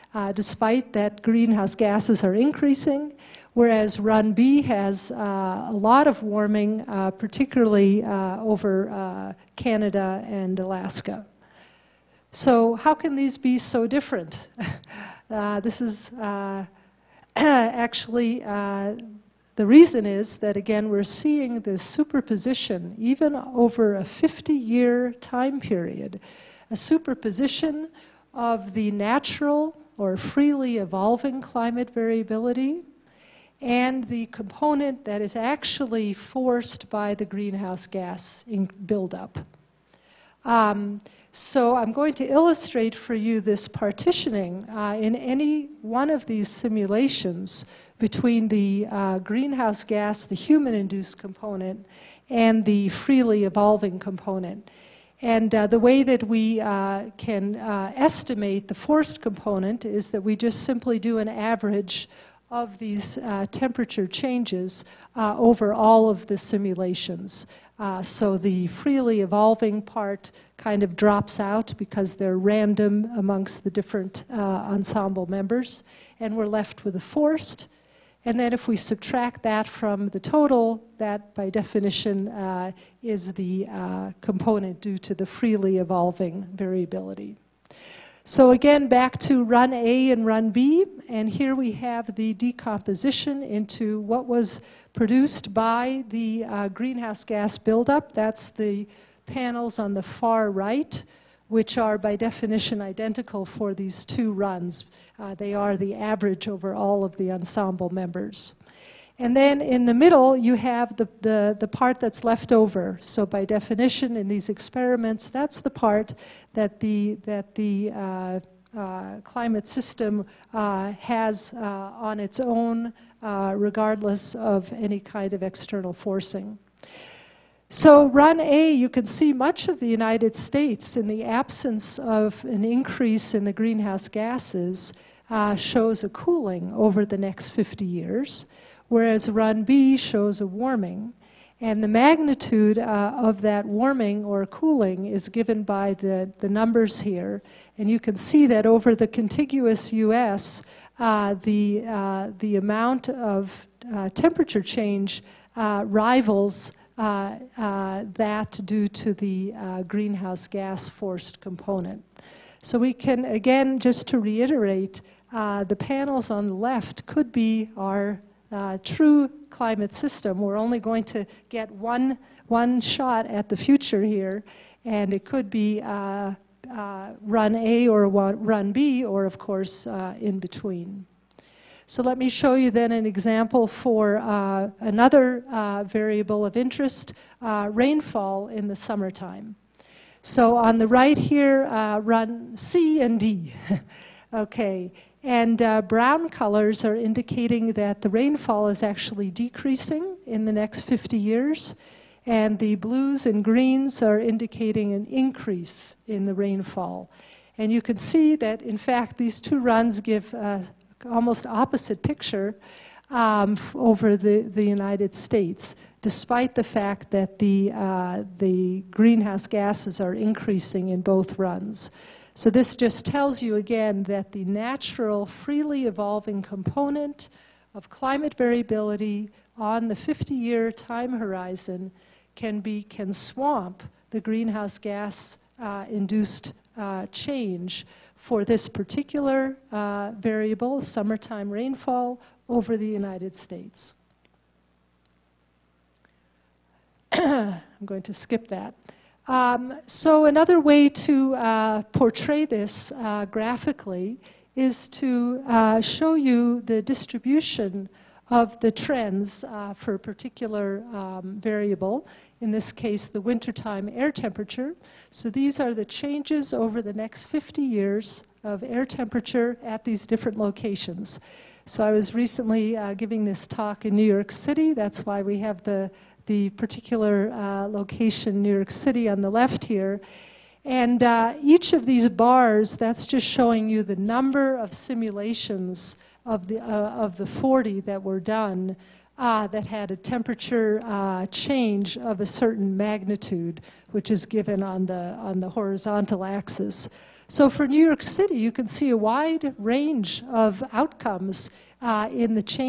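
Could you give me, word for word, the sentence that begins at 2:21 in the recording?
And the magnitude uh, of that warming or cooling is given by the, the numbers here.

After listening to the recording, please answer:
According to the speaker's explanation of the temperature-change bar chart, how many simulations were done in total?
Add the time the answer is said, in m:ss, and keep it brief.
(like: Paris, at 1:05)
40, at 4:47.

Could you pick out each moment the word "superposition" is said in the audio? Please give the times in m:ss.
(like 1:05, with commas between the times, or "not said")
0:21, 0:26.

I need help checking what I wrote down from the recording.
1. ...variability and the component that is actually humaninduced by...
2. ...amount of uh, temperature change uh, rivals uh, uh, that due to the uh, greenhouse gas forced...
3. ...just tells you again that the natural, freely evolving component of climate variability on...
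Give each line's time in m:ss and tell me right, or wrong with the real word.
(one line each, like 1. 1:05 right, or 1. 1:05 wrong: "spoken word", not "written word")
1. 0:31 wrong: "forced", not "humaninduced"
2. 2:32 right
3. 3:42 right.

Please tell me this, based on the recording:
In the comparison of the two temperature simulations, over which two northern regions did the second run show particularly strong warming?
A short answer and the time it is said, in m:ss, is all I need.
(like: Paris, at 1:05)
Canada and Alaska, at 0:09.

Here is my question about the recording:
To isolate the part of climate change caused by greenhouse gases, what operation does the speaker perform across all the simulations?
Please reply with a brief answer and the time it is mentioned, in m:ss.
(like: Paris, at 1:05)
an average, at 1:01.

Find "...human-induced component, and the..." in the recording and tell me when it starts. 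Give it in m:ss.
0:50.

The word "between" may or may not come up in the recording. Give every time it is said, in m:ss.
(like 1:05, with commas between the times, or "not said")
0:47, 3:00.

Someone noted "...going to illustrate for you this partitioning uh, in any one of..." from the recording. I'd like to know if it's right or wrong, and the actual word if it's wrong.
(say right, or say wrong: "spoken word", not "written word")
right.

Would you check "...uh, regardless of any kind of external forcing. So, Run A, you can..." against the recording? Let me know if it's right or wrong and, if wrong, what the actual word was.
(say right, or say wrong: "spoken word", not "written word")
right.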